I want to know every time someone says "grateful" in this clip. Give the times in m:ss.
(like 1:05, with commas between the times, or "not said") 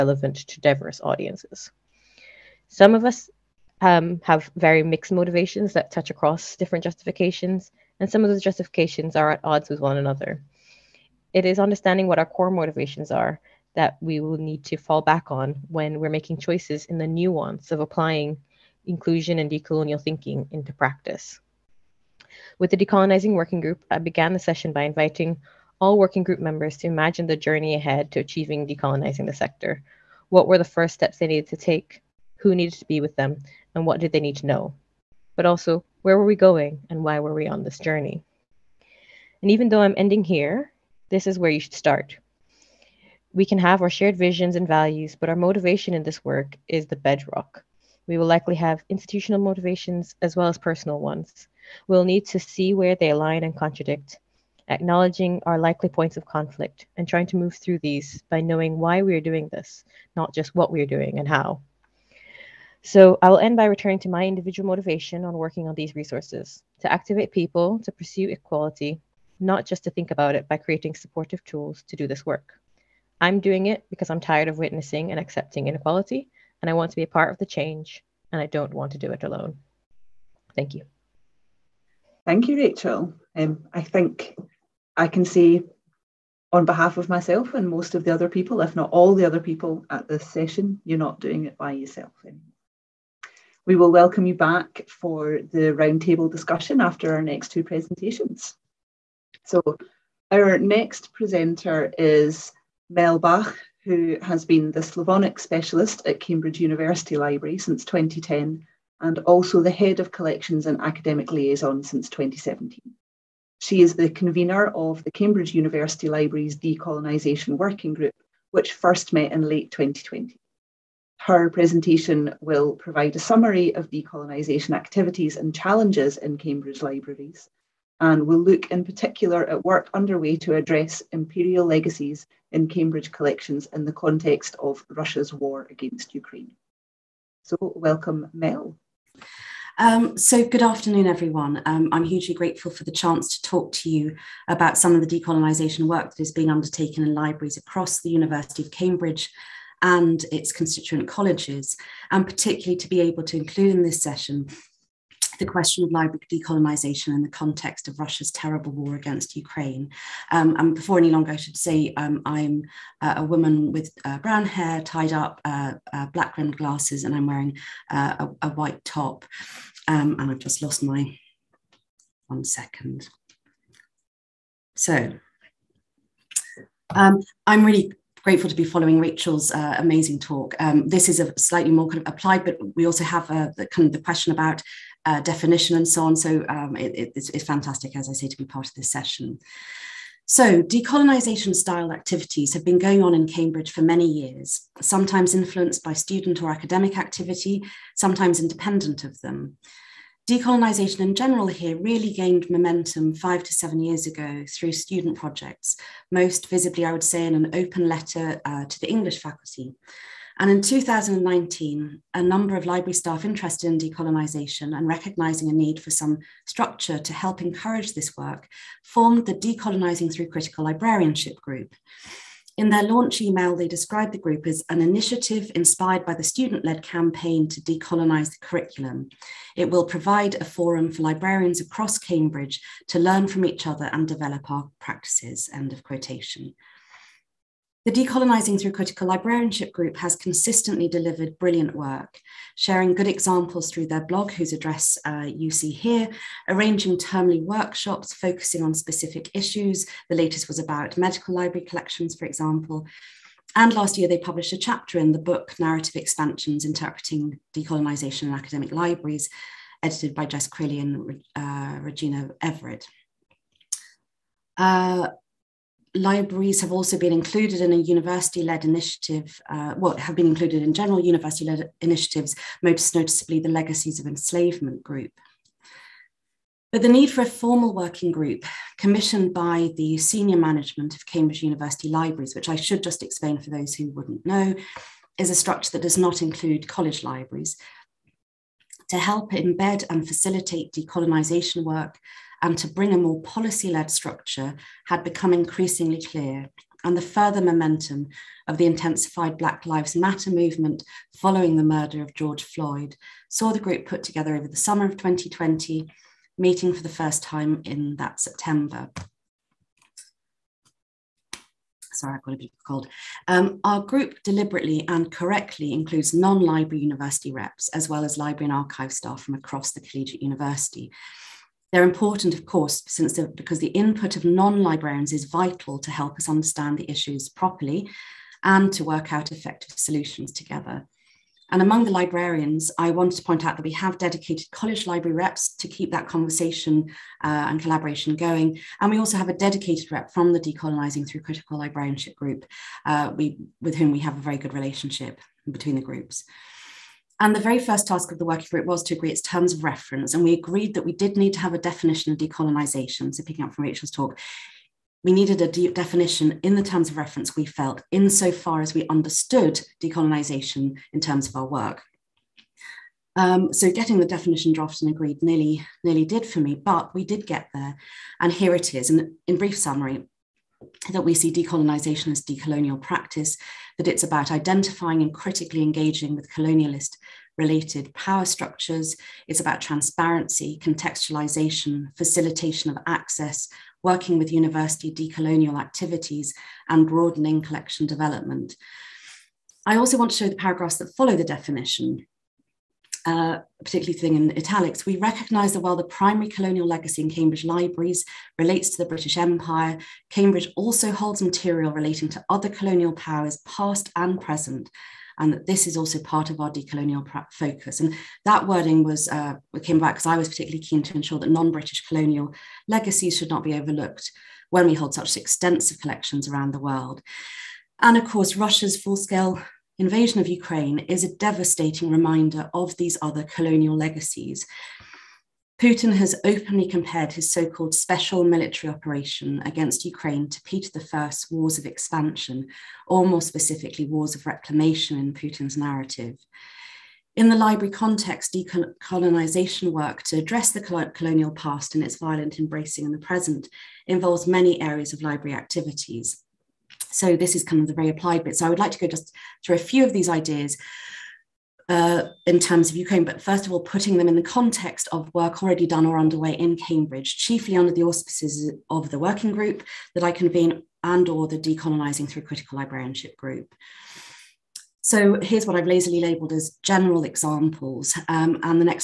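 2:22, 2:58.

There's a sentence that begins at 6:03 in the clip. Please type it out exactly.
Um, so getting the definition drafted and agreed nearly, nearly did for me, but we did get there.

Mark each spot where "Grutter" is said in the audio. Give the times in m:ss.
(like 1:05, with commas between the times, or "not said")
not said.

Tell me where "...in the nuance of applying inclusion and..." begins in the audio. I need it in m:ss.
0:16.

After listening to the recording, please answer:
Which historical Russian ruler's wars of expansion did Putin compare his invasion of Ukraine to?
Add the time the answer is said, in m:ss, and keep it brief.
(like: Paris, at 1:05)
Peter I, at 7:10.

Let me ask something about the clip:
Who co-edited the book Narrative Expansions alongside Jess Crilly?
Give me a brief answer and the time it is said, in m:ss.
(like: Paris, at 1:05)
Regina Everitt, at 4:21.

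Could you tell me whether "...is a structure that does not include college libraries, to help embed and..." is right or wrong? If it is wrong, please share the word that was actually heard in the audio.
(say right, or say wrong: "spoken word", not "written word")
right.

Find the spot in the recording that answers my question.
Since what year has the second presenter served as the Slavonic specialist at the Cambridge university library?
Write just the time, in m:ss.
1:47.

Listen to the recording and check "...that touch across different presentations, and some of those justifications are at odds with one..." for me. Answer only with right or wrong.
wrong.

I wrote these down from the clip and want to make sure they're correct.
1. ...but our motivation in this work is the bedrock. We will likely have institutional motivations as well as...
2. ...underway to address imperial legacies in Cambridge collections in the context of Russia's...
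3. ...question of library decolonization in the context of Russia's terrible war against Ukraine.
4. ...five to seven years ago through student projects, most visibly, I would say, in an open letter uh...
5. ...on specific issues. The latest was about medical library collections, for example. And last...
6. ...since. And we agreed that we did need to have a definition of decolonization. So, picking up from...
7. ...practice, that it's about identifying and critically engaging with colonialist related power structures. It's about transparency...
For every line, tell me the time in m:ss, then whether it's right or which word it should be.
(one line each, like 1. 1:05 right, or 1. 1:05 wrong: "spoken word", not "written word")
1. 0:45 right
2. 2:09 right
3. 2:35 right
4. 3:23 right
5. 4:08 right
6. 5:49 wrong: "reference", not "since"
7. 6:12 right.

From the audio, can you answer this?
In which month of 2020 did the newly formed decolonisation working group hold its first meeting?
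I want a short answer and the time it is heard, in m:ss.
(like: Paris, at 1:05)
September, at 5:08.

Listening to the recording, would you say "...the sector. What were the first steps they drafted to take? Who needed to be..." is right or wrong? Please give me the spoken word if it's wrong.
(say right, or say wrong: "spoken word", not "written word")
wrong: "needed", not "drafted".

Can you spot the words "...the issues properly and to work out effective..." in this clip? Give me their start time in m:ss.
5:26.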